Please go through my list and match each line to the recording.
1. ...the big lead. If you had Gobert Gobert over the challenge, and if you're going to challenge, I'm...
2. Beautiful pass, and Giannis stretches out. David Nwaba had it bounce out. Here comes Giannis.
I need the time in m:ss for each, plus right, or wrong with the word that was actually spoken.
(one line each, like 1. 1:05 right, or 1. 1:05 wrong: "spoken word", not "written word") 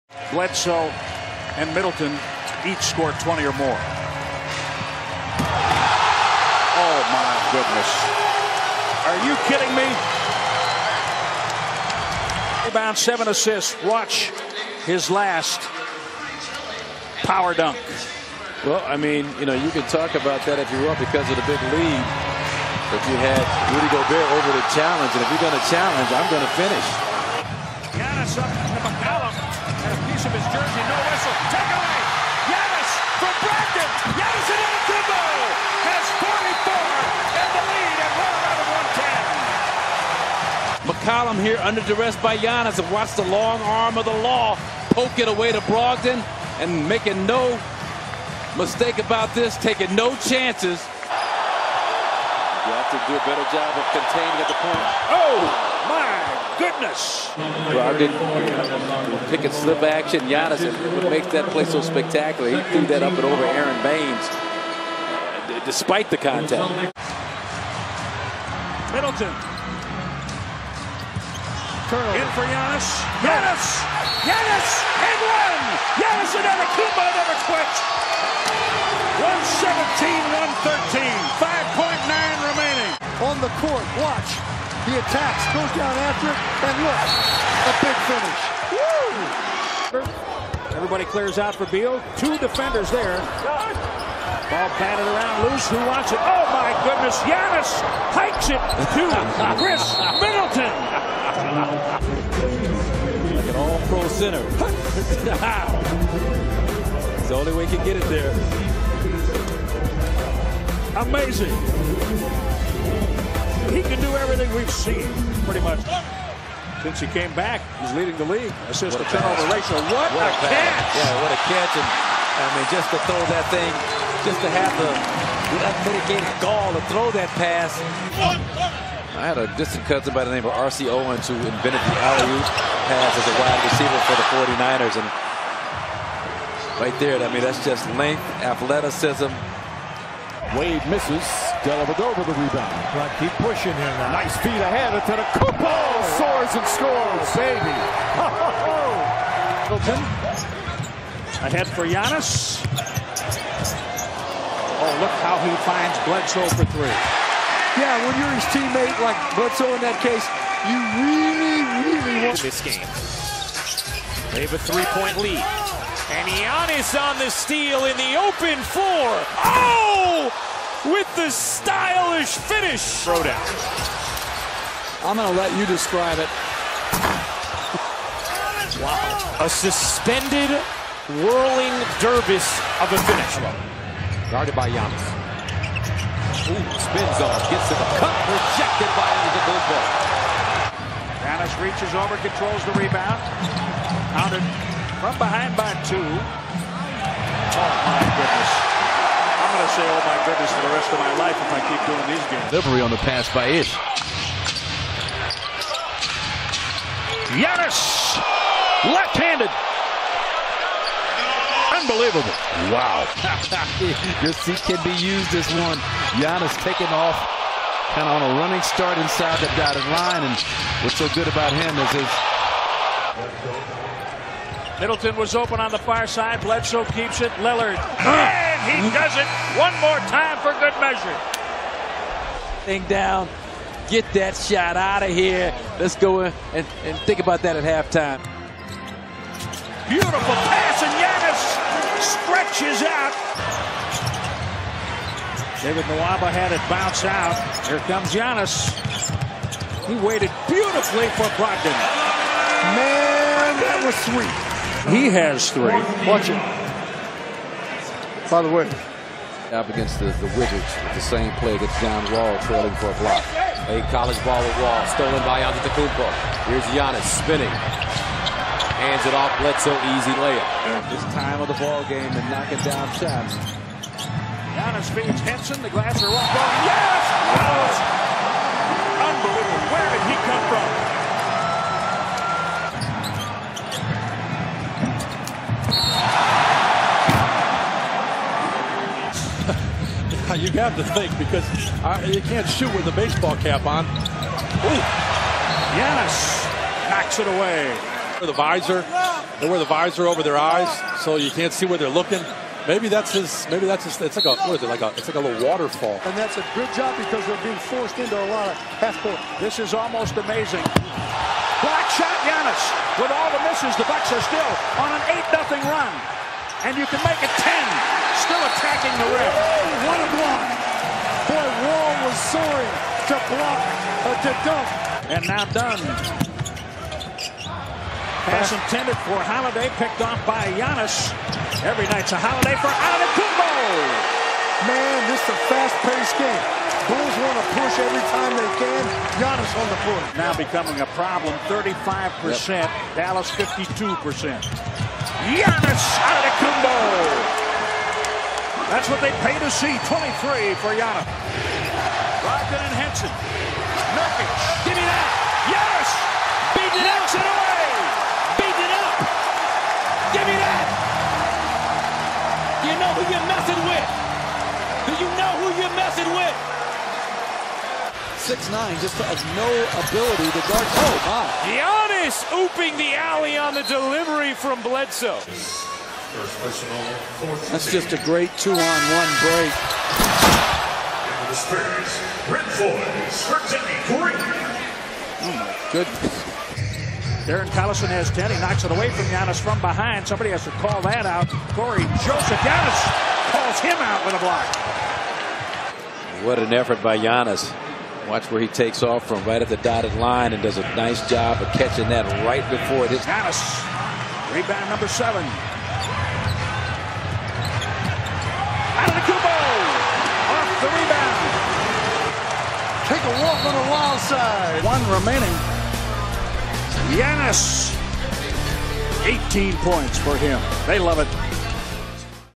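1. 0:21 wrong: "Rudy", not "Gobert"
2. 3:59 right.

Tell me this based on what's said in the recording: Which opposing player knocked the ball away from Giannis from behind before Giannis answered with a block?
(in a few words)
Cory Joseph.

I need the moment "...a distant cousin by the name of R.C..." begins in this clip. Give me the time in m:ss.
2:09.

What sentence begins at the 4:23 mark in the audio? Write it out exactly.
A college ball with Wall, stolen by Antetokounmpo.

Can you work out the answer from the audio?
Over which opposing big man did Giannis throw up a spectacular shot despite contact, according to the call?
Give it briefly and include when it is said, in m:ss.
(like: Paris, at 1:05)
Aron Baynes, at 1:03.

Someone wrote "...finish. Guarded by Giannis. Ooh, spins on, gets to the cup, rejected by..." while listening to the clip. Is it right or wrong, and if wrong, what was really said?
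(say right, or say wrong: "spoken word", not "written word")
right.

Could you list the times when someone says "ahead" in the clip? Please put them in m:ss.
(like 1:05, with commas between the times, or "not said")
2:24, 2:31.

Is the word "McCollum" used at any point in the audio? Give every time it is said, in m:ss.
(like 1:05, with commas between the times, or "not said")
0:28, 0:41.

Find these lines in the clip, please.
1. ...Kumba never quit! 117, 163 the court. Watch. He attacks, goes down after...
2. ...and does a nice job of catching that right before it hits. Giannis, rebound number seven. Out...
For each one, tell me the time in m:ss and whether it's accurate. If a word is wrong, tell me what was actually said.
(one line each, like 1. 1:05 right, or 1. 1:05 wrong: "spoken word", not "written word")
1. 1:16 wrong: "113", not "163"
2. 6:40 right.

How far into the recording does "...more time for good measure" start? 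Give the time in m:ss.
3:49.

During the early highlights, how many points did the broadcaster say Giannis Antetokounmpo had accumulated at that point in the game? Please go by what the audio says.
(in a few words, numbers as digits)
44.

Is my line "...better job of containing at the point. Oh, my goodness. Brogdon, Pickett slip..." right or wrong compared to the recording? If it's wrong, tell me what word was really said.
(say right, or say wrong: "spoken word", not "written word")
right.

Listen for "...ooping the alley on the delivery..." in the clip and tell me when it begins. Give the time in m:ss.
6:12.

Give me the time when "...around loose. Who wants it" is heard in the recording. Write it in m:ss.
1:35.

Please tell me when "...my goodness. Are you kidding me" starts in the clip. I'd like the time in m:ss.
0:07.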